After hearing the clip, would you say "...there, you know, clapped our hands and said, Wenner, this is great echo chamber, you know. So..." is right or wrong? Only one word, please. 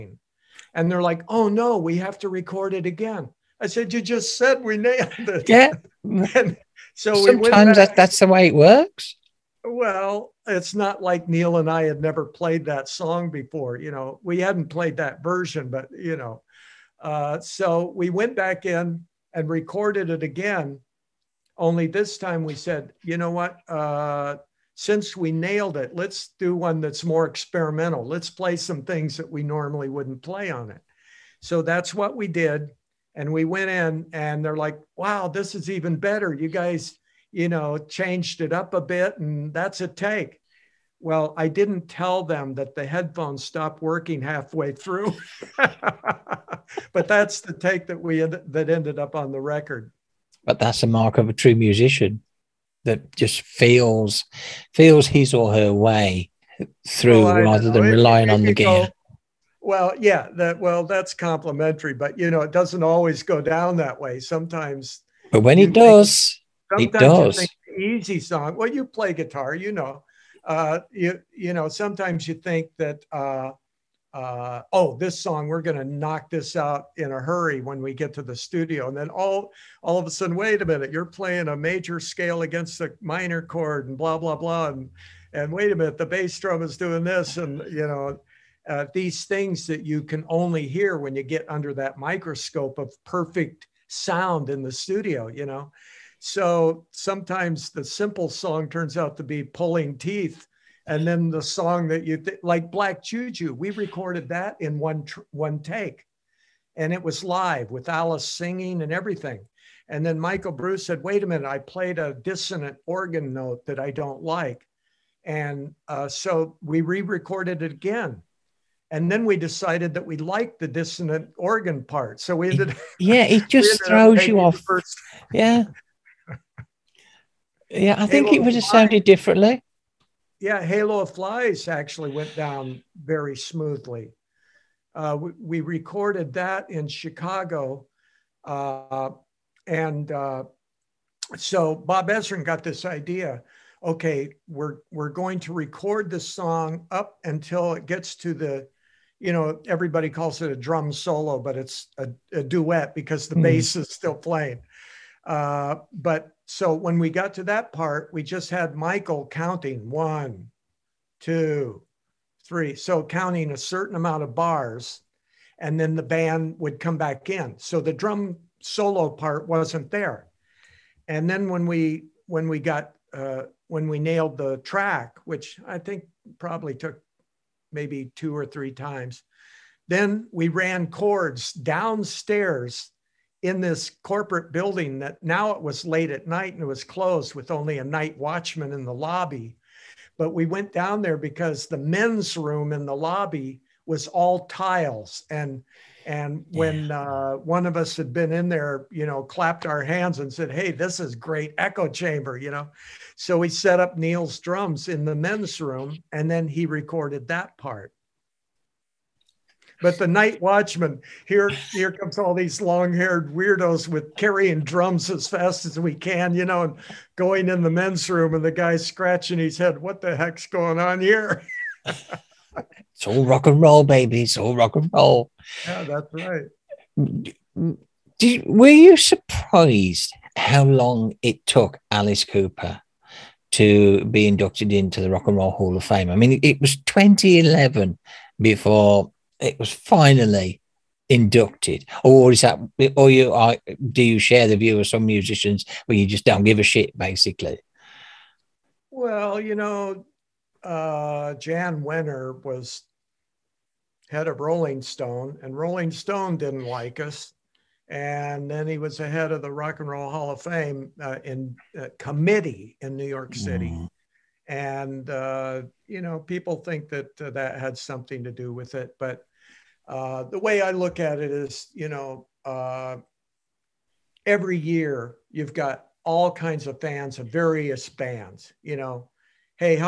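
wrong.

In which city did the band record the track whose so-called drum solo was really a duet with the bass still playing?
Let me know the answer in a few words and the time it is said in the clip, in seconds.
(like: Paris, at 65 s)
Chicago, at 136 s.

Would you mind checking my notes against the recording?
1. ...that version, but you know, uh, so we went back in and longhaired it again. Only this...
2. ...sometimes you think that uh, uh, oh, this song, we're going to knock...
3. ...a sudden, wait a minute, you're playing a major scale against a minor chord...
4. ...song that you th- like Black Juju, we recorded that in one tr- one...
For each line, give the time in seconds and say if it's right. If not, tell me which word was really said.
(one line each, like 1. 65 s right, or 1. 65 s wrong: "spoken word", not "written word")
1. 14 s wrong: "recorded", not "longhaired"
2. 71 s right
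3. 80 s right
4. 101 s right.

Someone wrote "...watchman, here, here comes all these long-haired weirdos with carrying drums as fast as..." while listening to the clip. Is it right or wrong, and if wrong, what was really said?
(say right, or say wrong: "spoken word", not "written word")
right.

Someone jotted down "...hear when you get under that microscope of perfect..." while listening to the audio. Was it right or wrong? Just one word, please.
right.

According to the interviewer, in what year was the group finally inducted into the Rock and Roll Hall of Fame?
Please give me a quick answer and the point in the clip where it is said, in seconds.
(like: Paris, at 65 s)
2011, at 236 s.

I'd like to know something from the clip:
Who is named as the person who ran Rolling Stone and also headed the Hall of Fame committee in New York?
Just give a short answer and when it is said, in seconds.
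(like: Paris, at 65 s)
Jan Wenner, at 251 s.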